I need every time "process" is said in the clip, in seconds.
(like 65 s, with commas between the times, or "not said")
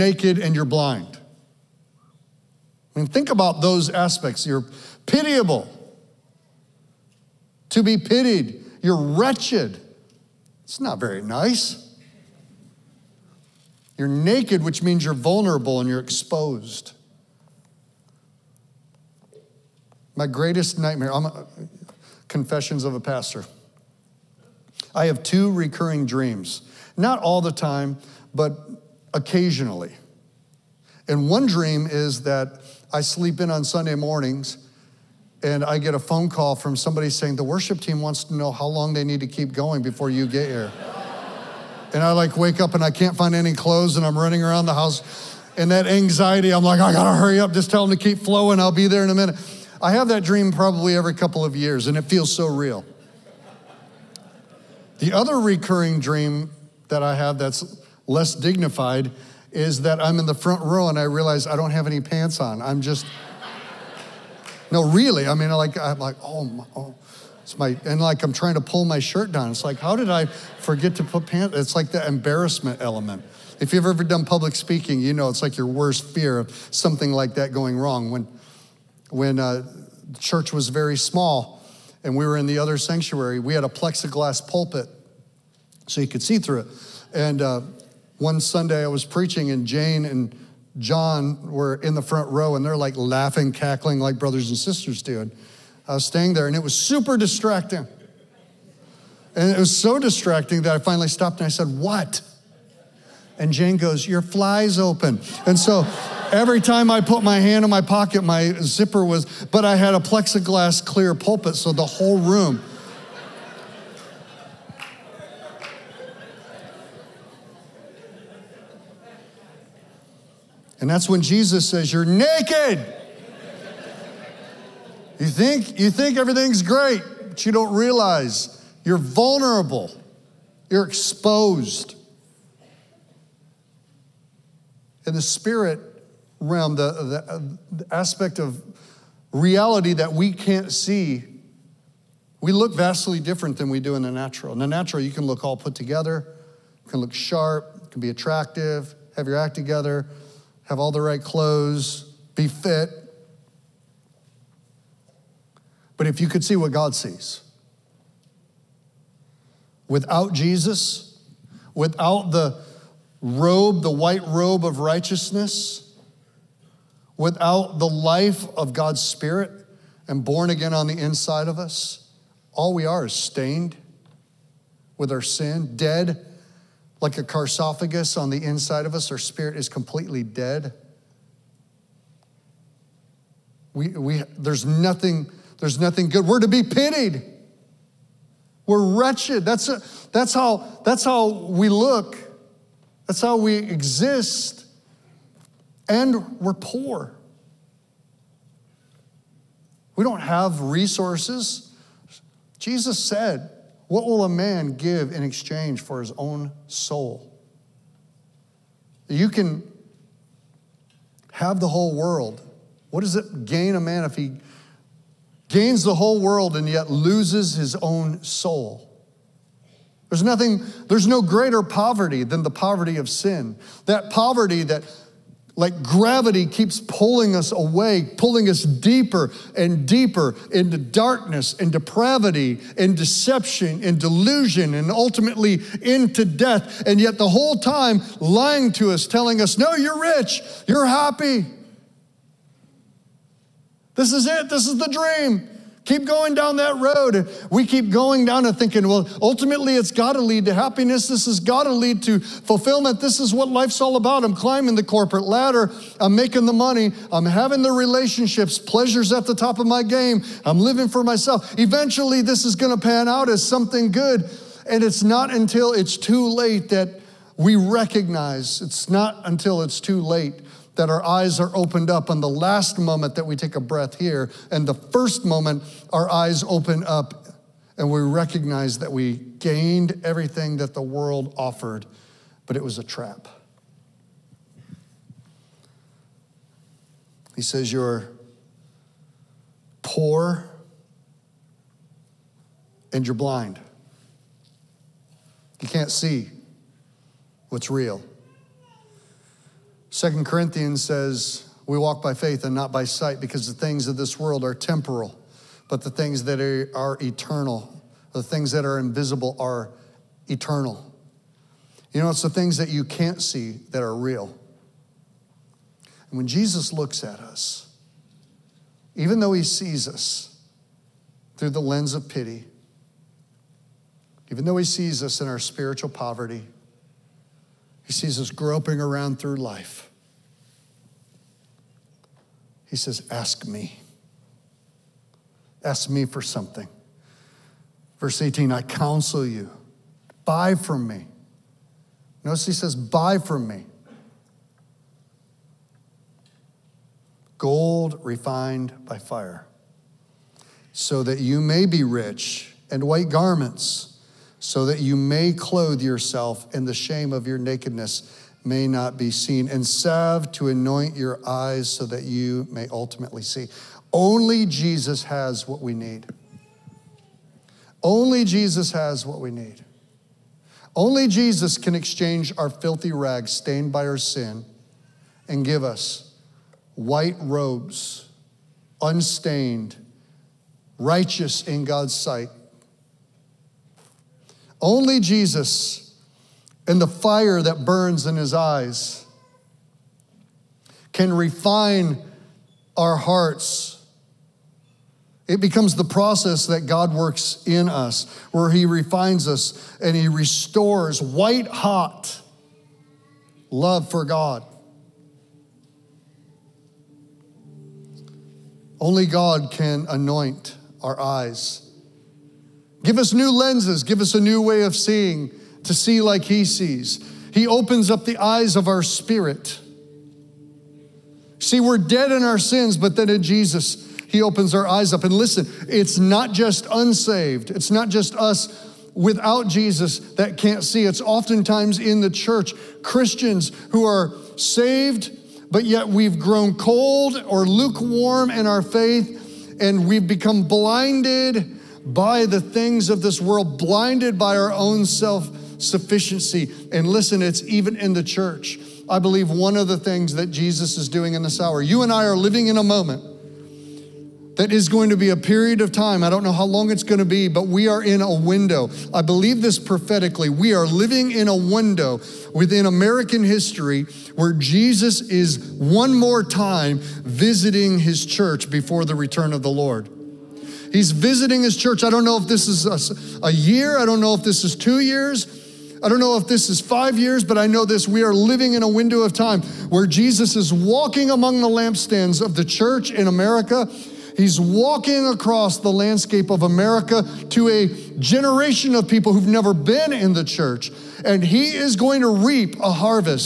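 395 s.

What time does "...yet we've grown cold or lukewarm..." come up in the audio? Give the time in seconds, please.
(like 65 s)
435 s.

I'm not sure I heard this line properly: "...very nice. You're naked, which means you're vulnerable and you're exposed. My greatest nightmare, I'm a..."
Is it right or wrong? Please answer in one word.
right.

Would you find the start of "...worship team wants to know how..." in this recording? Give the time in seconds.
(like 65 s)
37 s.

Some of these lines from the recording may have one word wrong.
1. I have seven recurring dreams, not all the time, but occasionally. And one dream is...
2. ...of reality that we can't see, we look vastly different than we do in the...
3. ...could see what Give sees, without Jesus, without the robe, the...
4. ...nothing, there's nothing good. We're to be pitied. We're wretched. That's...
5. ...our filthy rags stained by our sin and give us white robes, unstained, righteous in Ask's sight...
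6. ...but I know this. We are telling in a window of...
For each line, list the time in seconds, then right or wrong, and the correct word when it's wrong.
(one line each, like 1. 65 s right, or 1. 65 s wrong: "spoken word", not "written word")
1. 24 s wrong: "two", not "seven"
2. 138 s right
3. 156 s wrong: "God", not "Give"
4. 184 s right
5. 372 s wrong: "God", not "Ask"
6. 477 s wrong: "living", not "telling".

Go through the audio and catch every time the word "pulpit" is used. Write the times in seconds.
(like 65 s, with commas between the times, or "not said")
84 s, 111 s.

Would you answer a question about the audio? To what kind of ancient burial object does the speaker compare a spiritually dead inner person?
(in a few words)
Sarcophagus.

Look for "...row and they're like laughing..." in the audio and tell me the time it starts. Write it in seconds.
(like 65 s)
92 s.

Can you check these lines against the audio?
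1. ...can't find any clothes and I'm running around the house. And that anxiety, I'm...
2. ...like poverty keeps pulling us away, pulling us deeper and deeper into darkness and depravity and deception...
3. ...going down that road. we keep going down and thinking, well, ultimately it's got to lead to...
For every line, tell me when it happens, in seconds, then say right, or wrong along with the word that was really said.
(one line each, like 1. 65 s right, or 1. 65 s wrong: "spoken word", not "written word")
1. 42 s right
2. 225 s wrong: "gravity", not "poverty"
3. 246 s right.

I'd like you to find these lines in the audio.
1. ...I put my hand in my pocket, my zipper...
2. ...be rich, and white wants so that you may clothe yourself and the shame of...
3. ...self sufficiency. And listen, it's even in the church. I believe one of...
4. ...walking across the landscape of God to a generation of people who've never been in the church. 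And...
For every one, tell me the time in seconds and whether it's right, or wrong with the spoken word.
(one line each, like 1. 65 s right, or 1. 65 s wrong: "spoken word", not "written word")
1. 106 s right
2. 351 s wrong: "garments", not "wants"
3. 444 s right
4. 484 s wrong: "America", not "God".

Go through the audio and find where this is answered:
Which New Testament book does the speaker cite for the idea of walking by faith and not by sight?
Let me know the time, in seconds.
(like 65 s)
299 s.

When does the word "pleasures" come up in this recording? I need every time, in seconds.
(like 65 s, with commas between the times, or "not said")
258 s.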